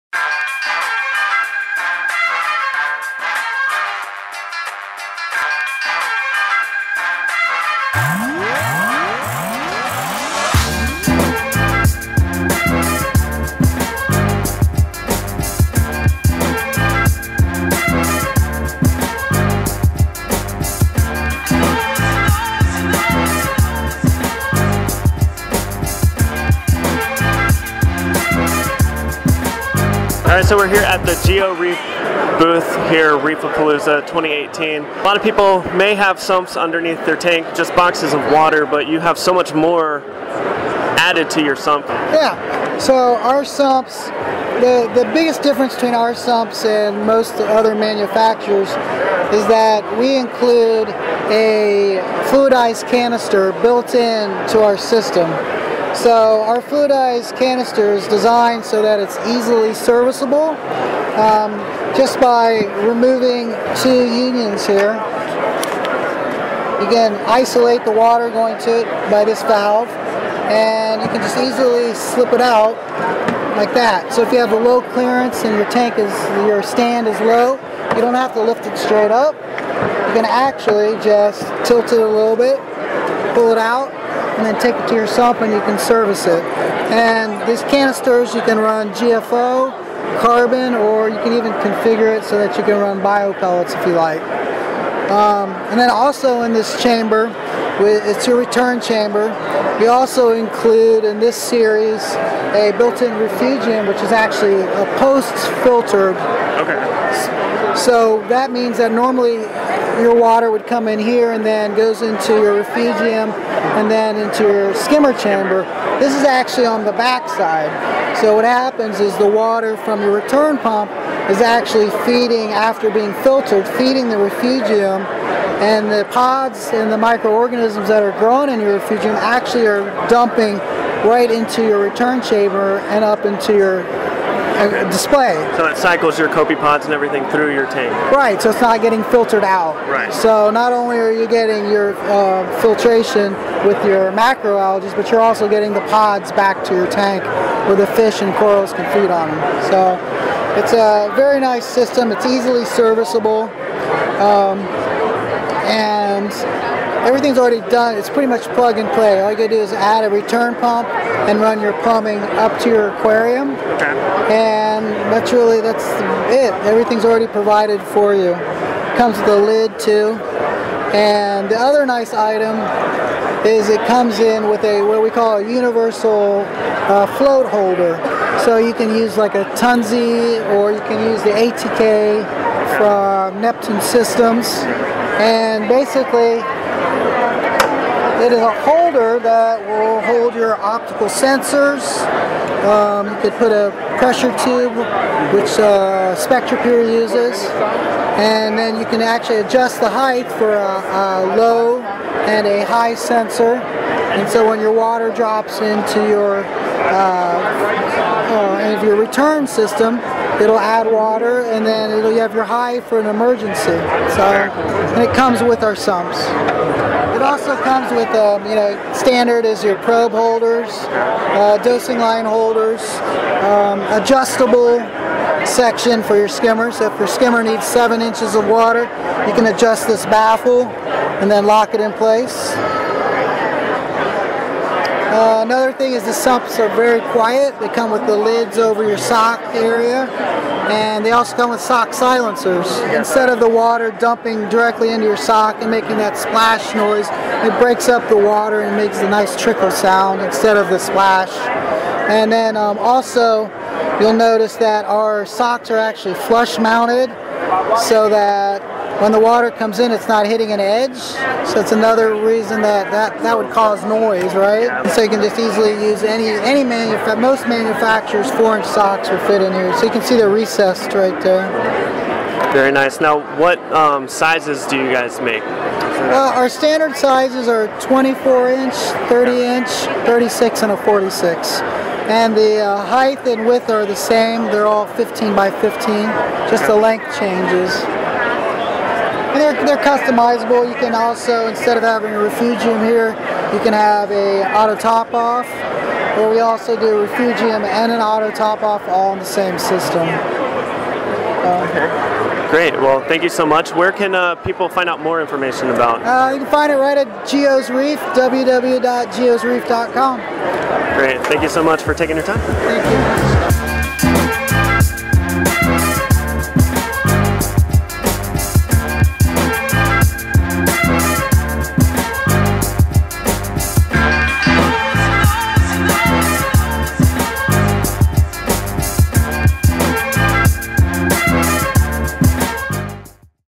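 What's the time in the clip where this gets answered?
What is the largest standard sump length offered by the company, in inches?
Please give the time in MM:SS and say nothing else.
04:40.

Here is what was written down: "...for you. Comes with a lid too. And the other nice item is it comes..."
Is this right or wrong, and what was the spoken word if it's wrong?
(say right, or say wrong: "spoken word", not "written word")
right.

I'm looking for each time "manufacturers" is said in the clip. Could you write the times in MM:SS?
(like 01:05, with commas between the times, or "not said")
00:47, 04:27.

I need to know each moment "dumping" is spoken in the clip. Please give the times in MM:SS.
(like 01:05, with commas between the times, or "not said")
02:10, 04:03.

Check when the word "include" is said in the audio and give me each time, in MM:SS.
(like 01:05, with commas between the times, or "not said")
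00:50, 01:40.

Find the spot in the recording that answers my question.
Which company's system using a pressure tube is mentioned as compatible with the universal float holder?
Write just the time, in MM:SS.
03:16.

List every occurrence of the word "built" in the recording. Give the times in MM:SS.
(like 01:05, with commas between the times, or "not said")
00:53, 01:42.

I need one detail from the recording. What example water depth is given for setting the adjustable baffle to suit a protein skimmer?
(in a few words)
7 inches.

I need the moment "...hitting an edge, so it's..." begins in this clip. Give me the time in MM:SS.
04:20.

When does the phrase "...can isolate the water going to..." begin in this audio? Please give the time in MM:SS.
01:06.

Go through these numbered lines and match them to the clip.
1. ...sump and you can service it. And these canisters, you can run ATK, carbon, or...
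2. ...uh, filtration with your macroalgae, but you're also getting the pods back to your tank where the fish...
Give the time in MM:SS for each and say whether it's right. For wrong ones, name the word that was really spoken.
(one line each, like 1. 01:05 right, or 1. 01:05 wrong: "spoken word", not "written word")
1. 01:25 wrong: "GFO", not "ATK"
2. 02:22 right.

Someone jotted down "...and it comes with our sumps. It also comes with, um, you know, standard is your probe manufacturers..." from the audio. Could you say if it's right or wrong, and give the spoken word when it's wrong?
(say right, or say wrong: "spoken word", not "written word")
wrong: "holders", not "manufacturers".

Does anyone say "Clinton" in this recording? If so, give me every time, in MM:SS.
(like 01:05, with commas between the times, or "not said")
not said.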